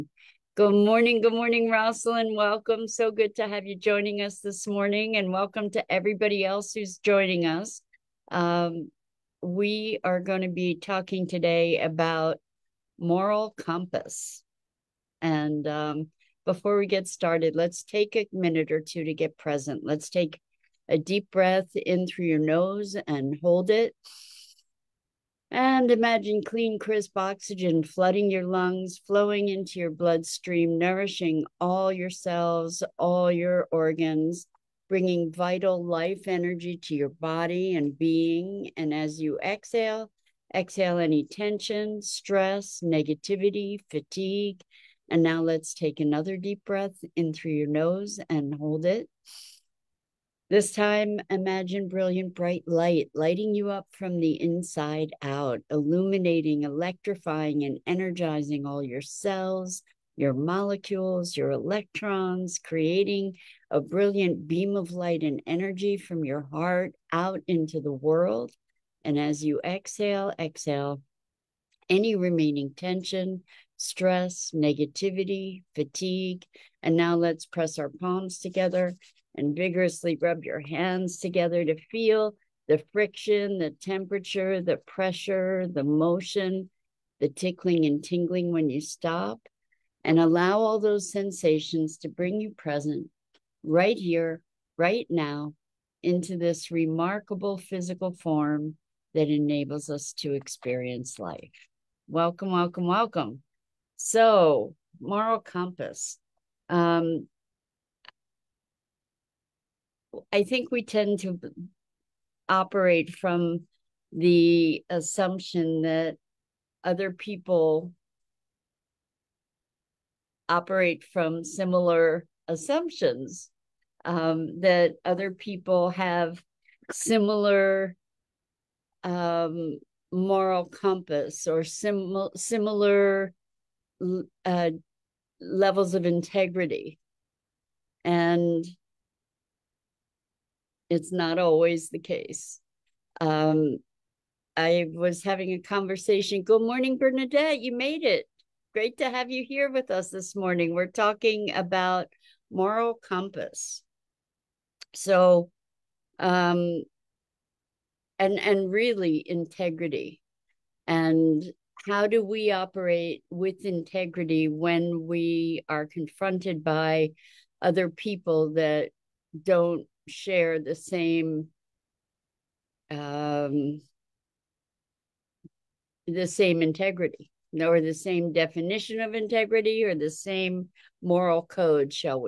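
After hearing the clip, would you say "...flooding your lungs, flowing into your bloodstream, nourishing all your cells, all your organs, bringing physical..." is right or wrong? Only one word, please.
wrong.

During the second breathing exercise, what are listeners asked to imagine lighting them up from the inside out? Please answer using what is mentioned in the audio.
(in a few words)
brilliant bright light.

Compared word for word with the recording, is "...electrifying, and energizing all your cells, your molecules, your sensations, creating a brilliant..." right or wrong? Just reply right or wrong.
wrong.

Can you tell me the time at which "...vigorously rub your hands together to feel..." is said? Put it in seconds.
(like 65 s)
79 s.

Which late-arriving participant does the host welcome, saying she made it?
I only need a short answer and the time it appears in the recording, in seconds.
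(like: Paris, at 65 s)
Bernadette, at 146 s.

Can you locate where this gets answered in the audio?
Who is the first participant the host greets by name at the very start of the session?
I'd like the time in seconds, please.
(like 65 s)
1 s.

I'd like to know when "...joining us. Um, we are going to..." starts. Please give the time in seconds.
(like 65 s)
6 s.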